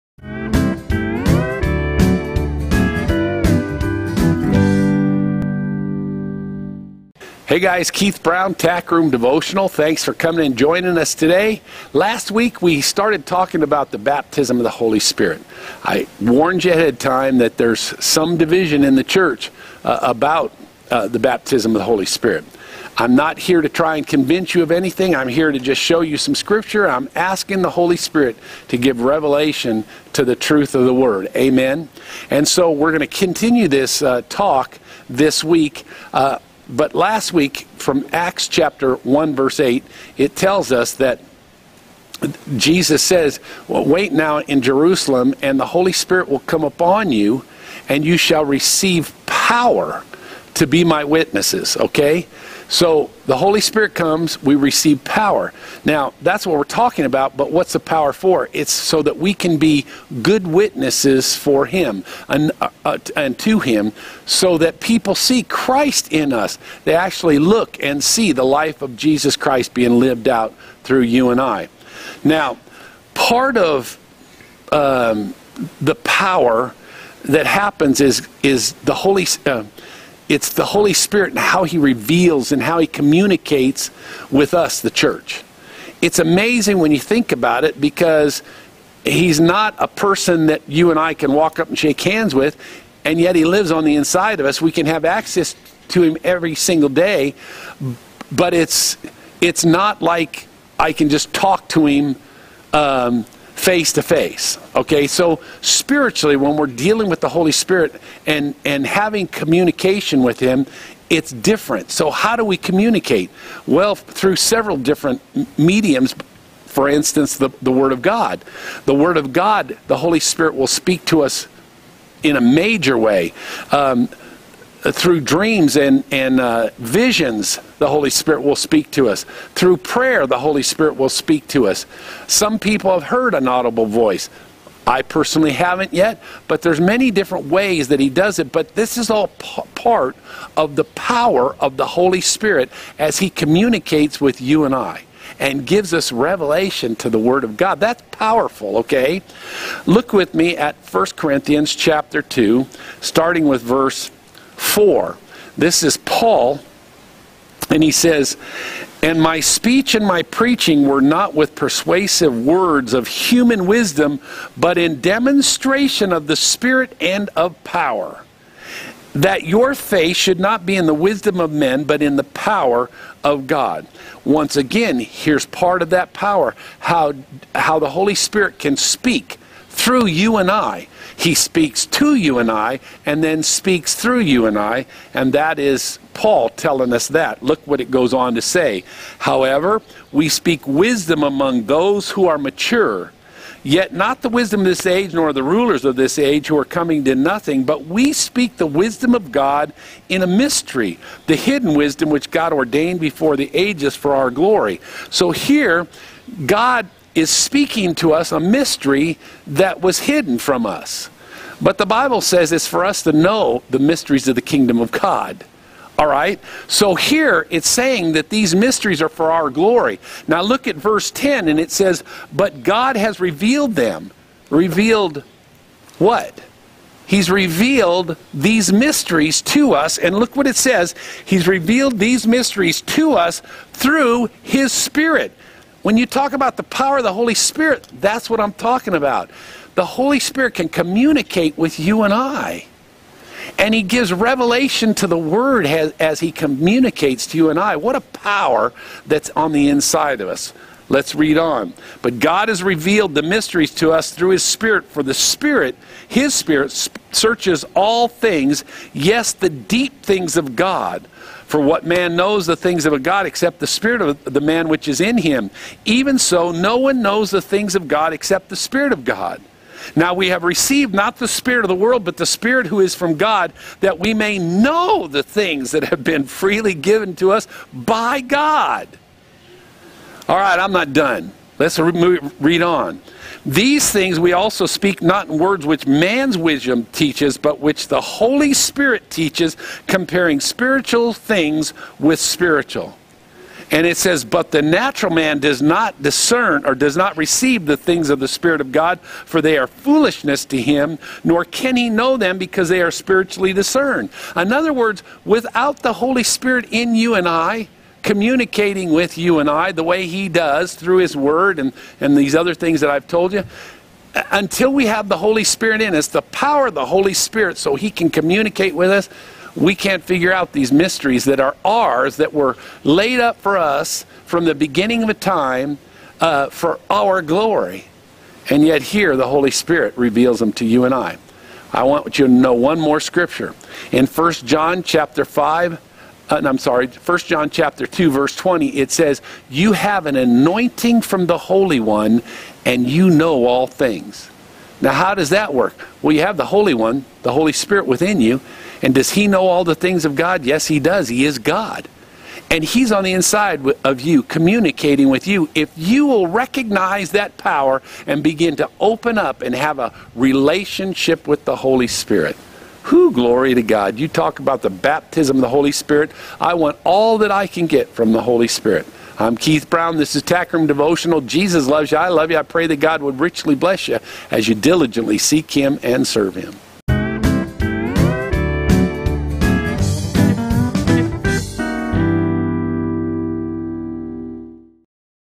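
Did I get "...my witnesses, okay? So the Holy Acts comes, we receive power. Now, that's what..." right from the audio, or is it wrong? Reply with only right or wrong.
wrong.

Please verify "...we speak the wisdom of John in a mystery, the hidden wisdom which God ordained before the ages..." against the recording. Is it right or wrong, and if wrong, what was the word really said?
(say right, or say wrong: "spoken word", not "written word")
wrong: "God", not "John".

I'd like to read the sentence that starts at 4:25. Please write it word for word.
Even so, no one knows the things of God except the spirit of God.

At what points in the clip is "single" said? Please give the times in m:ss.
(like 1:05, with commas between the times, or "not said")
1:36.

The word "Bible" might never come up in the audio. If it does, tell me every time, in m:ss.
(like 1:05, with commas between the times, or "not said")
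3:31.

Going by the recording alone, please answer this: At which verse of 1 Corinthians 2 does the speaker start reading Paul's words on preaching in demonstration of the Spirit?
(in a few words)
4.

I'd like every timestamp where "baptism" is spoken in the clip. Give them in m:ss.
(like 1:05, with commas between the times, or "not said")
0:13, 0:21, 6:04.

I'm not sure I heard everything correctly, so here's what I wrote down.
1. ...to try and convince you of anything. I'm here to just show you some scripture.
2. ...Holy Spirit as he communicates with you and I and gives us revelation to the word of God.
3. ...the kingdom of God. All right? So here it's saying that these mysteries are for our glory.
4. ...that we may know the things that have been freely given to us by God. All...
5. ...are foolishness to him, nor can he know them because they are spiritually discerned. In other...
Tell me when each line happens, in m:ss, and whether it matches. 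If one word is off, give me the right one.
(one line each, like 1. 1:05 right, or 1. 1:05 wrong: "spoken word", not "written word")
1. 0:23 right
2. 2:21 right
3. 3:34 right
4. 4:33 right
5. 4:59 right.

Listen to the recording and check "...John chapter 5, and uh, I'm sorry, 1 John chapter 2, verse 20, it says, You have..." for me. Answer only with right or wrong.
right.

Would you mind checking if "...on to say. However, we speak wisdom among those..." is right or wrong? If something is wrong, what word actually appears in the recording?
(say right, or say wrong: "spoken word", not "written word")
right.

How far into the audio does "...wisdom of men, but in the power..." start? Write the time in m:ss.
2:50.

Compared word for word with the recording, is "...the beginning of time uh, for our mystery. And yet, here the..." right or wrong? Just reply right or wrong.
wrong.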